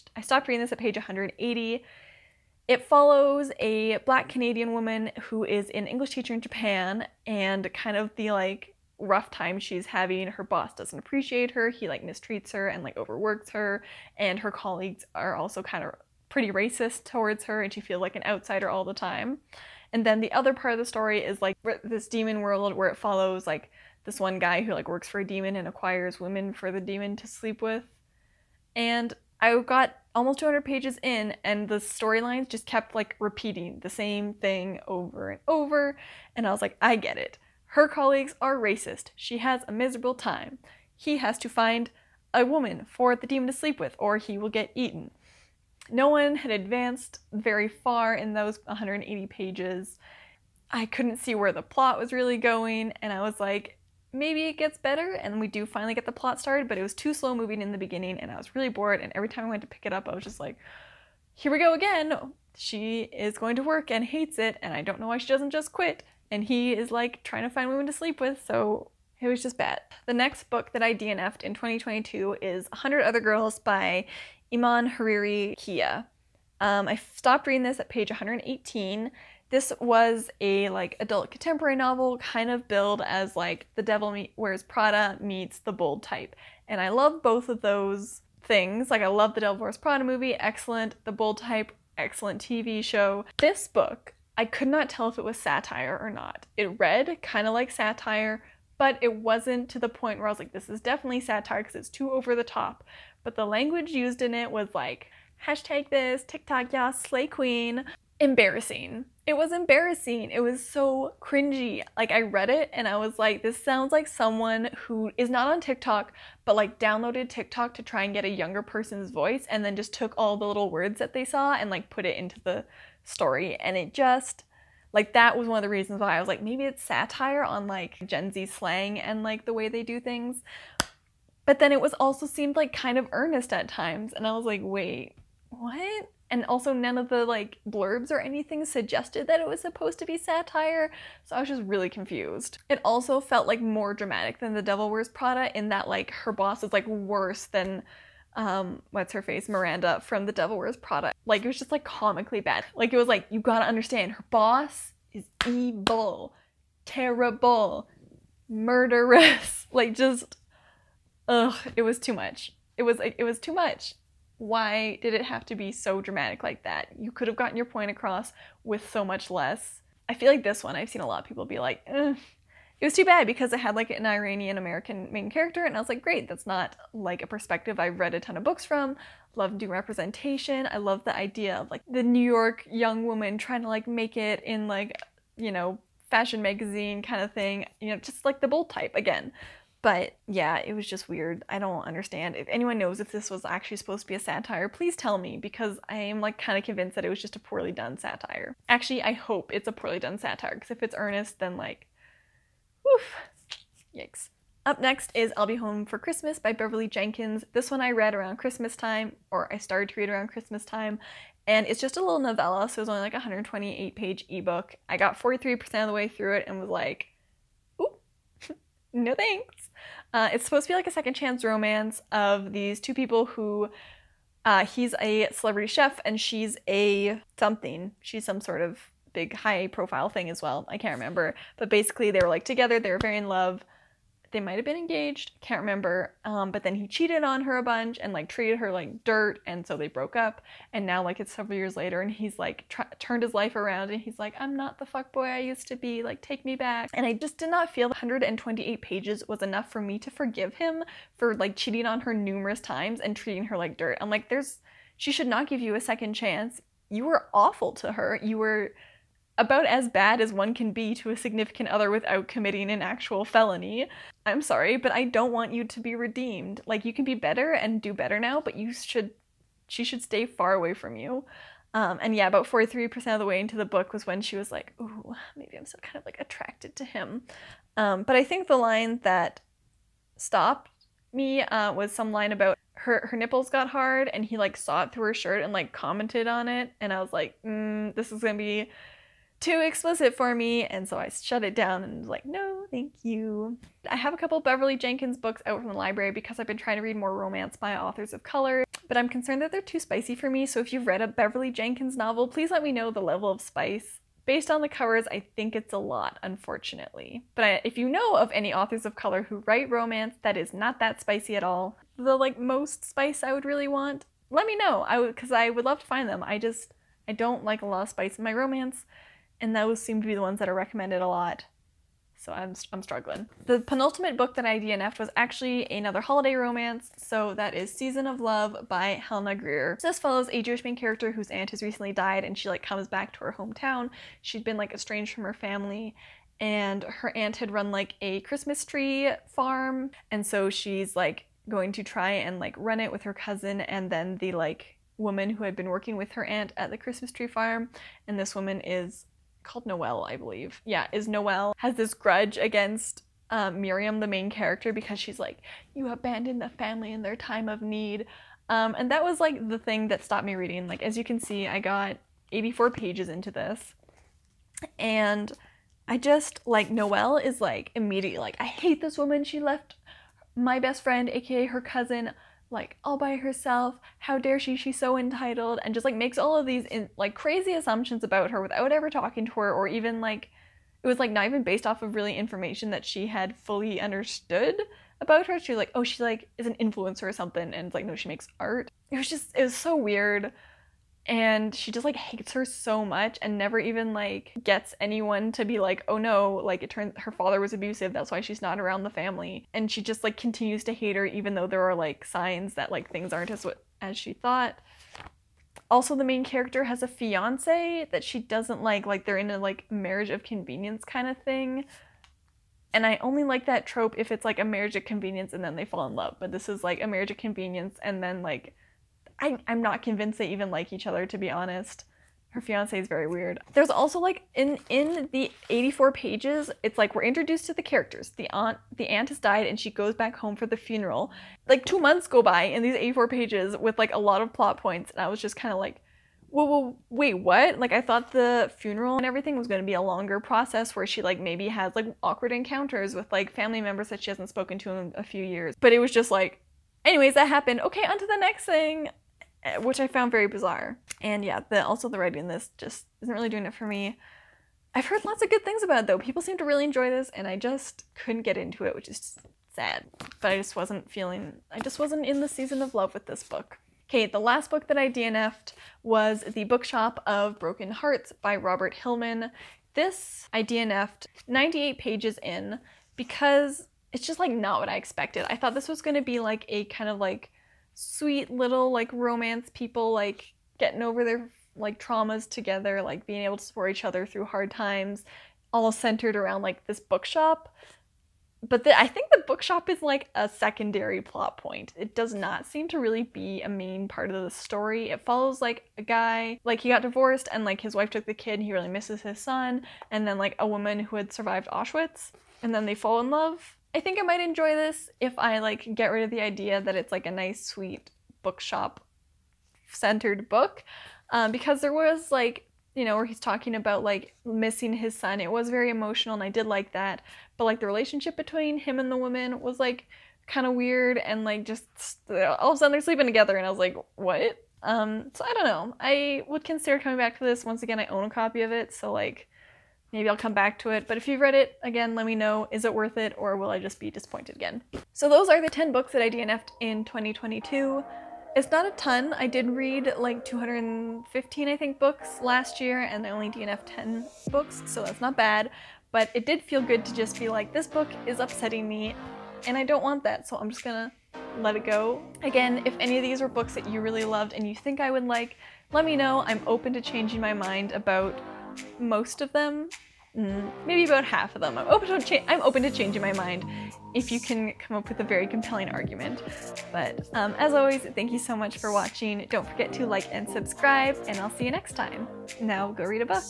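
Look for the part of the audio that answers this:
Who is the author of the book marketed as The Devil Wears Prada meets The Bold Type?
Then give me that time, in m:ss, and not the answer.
1:14.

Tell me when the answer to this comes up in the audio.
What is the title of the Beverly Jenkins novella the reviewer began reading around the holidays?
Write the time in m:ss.
3:25.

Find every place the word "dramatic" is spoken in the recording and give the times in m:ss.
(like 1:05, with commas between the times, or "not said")
2:23, 2:46.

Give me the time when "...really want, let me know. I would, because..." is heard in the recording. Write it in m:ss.
5:13.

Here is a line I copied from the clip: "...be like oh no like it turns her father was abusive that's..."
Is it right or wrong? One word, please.
right.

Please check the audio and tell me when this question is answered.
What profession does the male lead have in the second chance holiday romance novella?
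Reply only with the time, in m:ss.
3:45.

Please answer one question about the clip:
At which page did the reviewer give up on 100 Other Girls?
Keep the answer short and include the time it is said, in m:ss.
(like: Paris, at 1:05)
118, at 1:17.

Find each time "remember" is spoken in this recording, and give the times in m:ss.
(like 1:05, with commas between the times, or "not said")
3:50, 3:55.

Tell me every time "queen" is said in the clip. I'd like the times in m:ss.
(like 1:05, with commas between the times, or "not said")
1:47.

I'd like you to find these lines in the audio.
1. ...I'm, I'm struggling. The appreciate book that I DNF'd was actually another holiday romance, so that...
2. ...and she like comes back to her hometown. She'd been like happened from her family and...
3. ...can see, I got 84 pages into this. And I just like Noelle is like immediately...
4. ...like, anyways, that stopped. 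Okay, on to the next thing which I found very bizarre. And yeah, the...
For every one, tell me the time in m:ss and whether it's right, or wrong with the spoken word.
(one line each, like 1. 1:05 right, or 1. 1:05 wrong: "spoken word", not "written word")
1. 5:22 wrong: "penultimate", not "appreciate"
2. 5:32 wrong: "estranged", not "happened"
3. 6:01 right
4. 7:26 wrong: "happened", not "stopped".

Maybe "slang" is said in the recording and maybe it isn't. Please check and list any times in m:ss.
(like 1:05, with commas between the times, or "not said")
2:08.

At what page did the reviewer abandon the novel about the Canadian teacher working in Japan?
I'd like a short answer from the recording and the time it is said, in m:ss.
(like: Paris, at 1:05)
180, at 0:00.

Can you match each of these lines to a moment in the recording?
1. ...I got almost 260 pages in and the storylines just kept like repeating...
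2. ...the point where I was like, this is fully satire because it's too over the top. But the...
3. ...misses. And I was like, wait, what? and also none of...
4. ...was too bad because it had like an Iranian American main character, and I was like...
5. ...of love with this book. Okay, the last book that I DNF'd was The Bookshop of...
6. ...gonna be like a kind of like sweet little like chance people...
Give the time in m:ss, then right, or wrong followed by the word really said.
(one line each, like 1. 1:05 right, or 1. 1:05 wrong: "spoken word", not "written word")
1. 0:29 wrong: "200", not "260"
2. 1:39 wrong: "definitely", not "fully"
3. 2:13 wrong: "times", not "misses"
4. 2:52 right
5. 7:42 right
6. 7:55 wrong: "romance", not "chance".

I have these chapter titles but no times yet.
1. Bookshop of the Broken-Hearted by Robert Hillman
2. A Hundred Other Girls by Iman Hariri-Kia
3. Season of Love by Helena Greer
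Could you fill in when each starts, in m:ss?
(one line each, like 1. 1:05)
1. 7:43
2. 1:09
3. 5:23.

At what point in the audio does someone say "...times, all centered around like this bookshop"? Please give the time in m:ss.
8:04.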